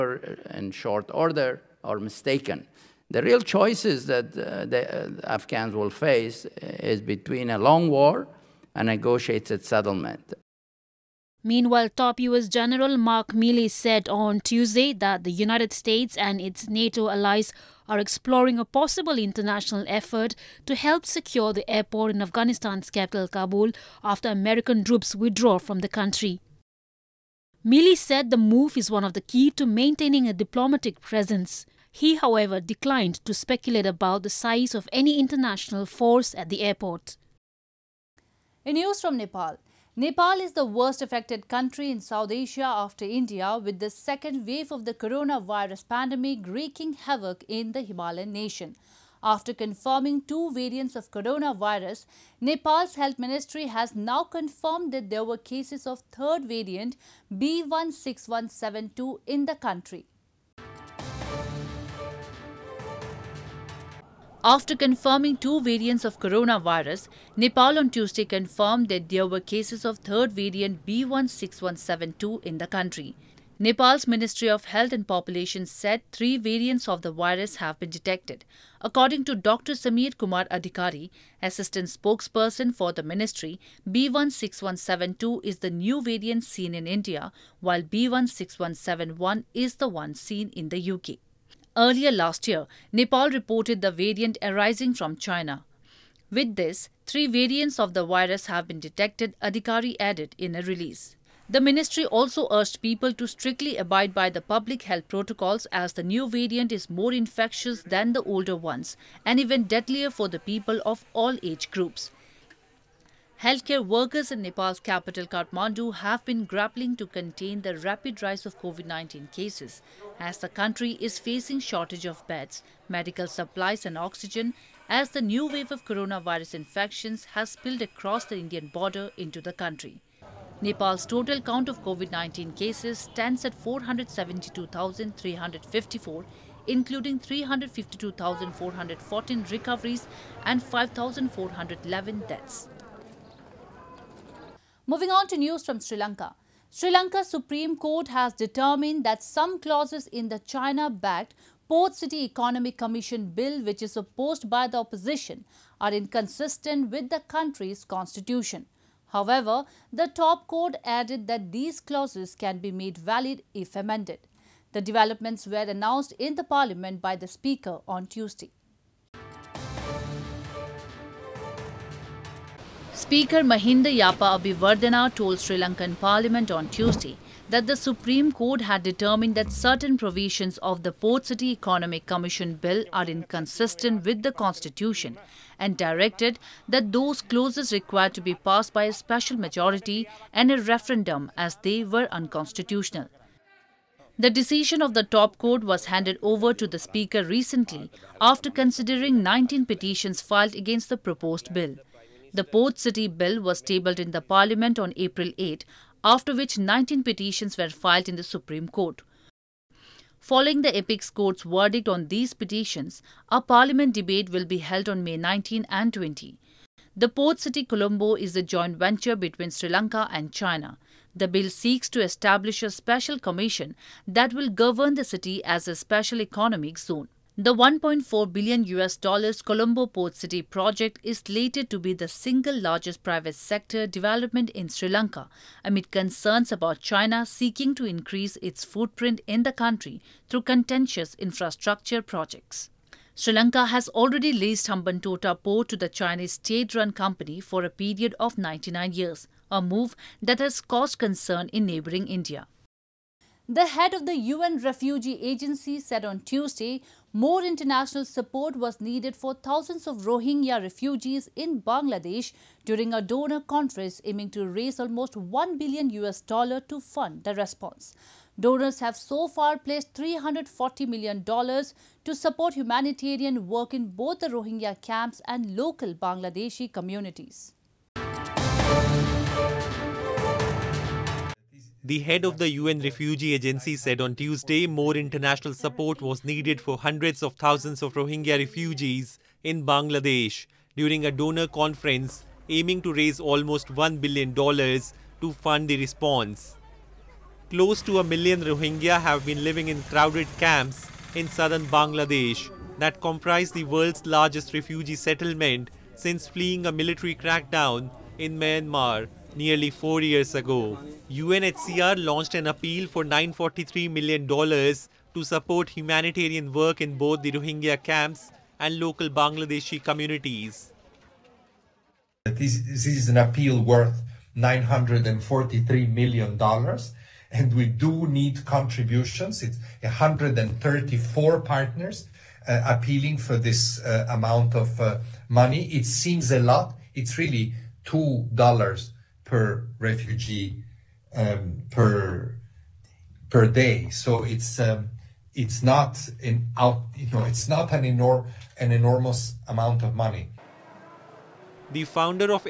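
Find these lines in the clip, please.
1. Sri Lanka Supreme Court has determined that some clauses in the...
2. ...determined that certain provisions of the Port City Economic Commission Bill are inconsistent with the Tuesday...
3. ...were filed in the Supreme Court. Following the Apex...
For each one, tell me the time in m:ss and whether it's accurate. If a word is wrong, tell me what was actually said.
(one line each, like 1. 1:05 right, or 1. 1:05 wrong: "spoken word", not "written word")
1. 2:26 right
2. 2:58 wrong: "Constitution", not "Tuesday"
3. 3:27 right.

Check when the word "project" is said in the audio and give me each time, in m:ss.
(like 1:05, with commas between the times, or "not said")
3:50, 4:02.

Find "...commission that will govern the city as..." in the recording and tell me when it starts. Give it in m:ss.
3:43.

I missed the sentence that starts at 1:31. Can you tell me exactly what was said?
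Earlier last year, Nepal reported the variant arising from China.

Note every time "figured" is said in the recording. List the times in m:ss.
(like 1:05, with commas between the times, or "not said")
not said.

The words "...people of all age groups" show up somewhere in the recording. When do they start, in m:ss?
1:50.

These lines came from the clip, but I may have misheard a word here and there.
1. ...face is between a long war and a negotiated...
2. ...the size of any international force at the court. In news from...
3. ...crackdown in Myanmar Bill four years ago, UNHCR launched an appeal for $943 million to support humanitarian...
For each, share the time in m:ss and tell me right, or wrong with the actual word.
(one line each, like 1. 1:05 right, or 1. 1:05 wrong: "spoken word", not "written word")
1. 0:05 right
2. 0:34 wrong: "airport", not "court"
3. 5:07 wrong: "Nearly", not "Bill".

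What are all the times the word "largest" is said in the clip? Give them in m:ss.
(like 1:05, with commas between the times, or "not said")
3:52, 5:04.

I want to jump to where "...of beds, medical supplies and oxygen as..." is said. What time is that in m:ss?
2:02.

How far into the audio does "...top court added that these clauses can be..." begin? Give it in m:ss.
2:40.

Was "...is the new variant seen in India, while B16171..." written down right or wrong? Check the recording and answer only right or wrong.
right.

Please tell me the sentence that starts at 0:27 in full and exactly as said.
Milley said the move is one of the key to maintaining a diplomatic presence.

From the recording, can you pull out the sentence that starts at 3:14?
The decision of the top court was handed over to the Speaker recently after considering 19 petitions filed against the proposed bill.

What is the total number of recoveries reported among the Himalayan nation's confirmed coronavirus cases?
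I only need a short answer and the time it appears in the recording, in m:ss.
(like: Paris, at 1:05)
352,414, at 2:17.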